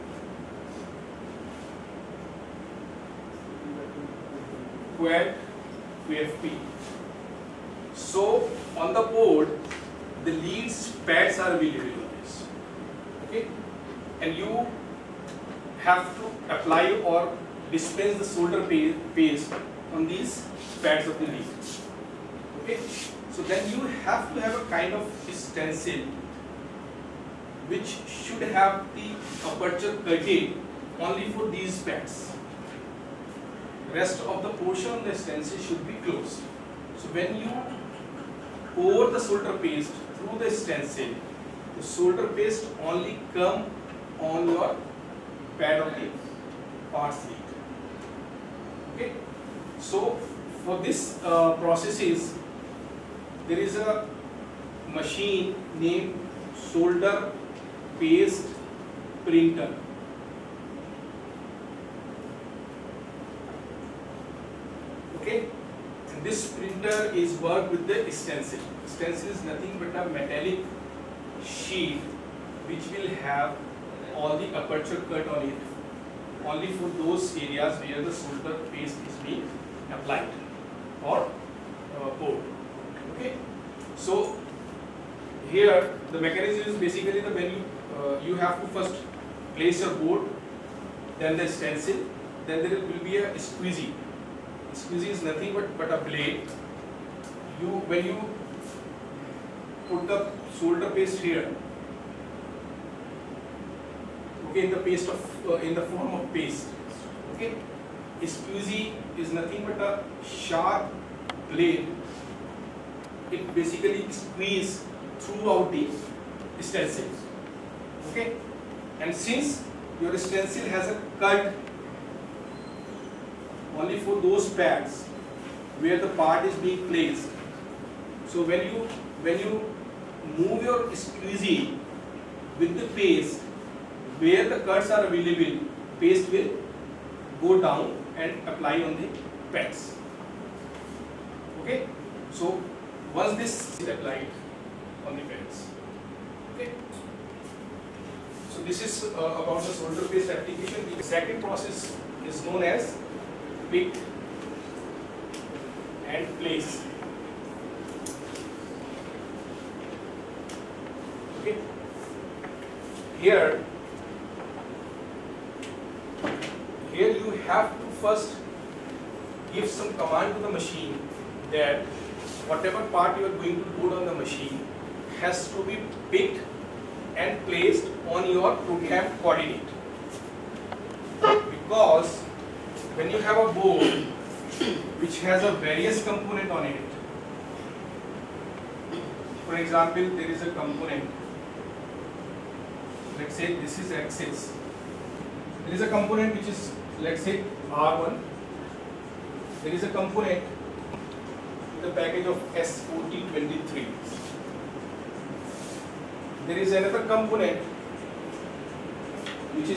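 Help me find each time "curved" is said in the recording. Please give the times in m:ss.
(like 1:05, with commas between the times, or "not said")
2:01.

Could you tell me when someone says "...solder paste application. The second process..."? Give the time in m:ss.
2:29.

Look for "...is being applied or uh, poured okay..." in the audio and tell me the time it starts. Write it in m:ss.
1:19.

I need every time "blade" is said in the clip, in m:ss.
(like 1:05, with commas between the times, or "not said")
1:36, 1:51.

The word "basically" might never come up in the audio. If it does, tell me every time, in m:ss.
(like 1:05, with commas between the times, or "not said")
1:26, 1:53.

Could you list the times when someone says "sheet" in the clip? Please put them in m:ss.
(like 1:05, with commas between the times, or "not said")
0:47, 1:11.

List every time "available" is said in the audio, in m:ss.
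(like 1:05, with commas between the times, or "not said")
0:11, 2:15.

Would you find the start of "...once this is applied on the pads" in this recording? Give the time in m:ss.
2:23.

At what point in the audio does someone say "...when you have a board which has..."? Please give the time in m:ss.
3:02.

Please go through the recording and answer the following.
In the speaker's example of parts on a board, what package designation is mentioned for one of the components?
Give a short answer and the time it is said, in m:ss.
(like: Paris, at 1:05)
S4023, at 3:22.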